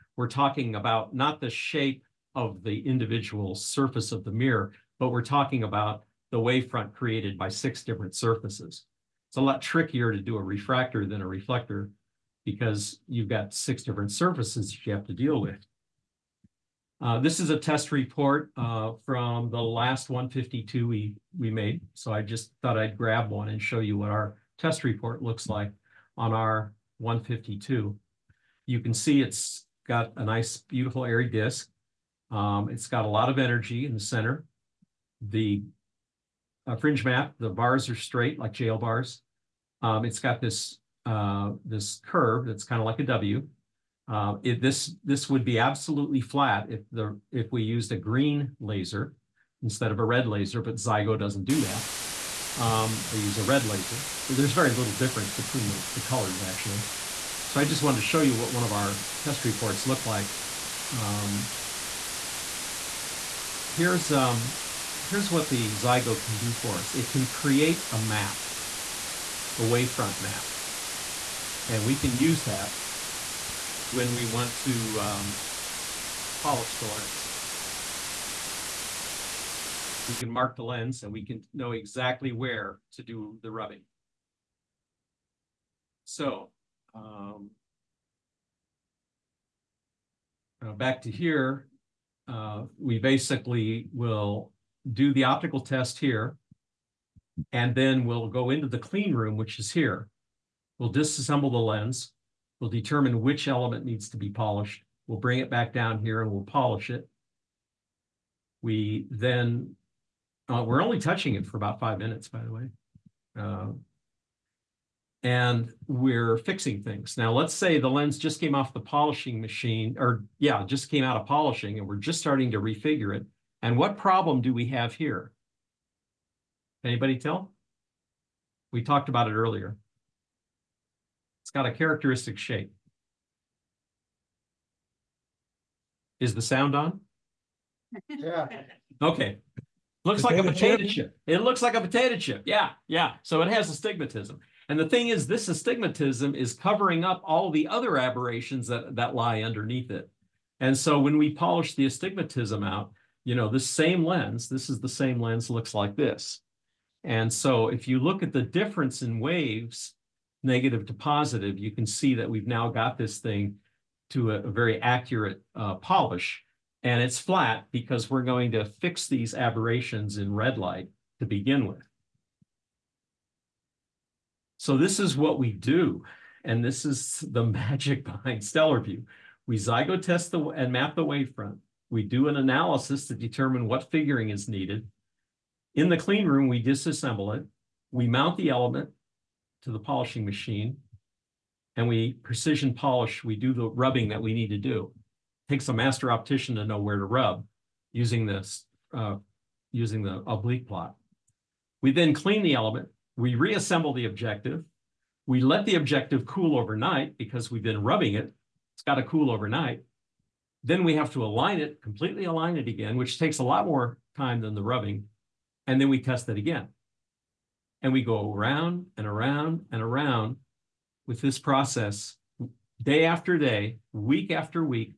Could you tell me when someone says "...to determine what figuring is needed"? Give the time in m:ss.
3:03.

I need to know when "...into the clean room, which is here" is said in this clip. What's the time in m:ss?
1:38.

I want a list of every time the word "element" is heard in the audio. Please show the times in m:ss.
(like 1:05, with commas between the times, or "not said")
1:43, 3:08, 3:22.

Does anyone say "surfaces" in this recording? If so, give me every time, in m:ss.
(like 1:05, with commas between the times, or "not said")
0:03, 0:08, 0:14.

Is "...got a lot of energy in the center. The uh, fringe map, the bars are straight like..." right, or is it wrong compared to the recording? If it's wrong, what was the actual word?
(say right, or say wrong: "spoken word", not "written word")
right.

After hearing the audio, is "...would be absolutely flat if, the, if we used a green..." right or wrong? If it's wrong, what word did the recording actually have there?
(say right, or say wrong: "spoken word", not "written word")
right.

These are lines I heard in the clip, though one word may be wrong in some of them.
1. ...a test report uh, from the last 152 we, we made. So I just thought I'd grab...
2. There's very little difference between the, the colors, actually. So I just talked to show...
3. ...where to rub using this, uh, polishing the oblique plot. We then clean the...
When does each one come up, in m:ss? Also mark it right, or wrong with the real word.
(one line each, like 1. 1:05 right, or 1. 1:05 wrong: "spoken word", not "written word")
1. 0:17 right
2. 0:54 wrong: "wanted", not "talked"
3. 3:16 wrong: "using", not "polishing".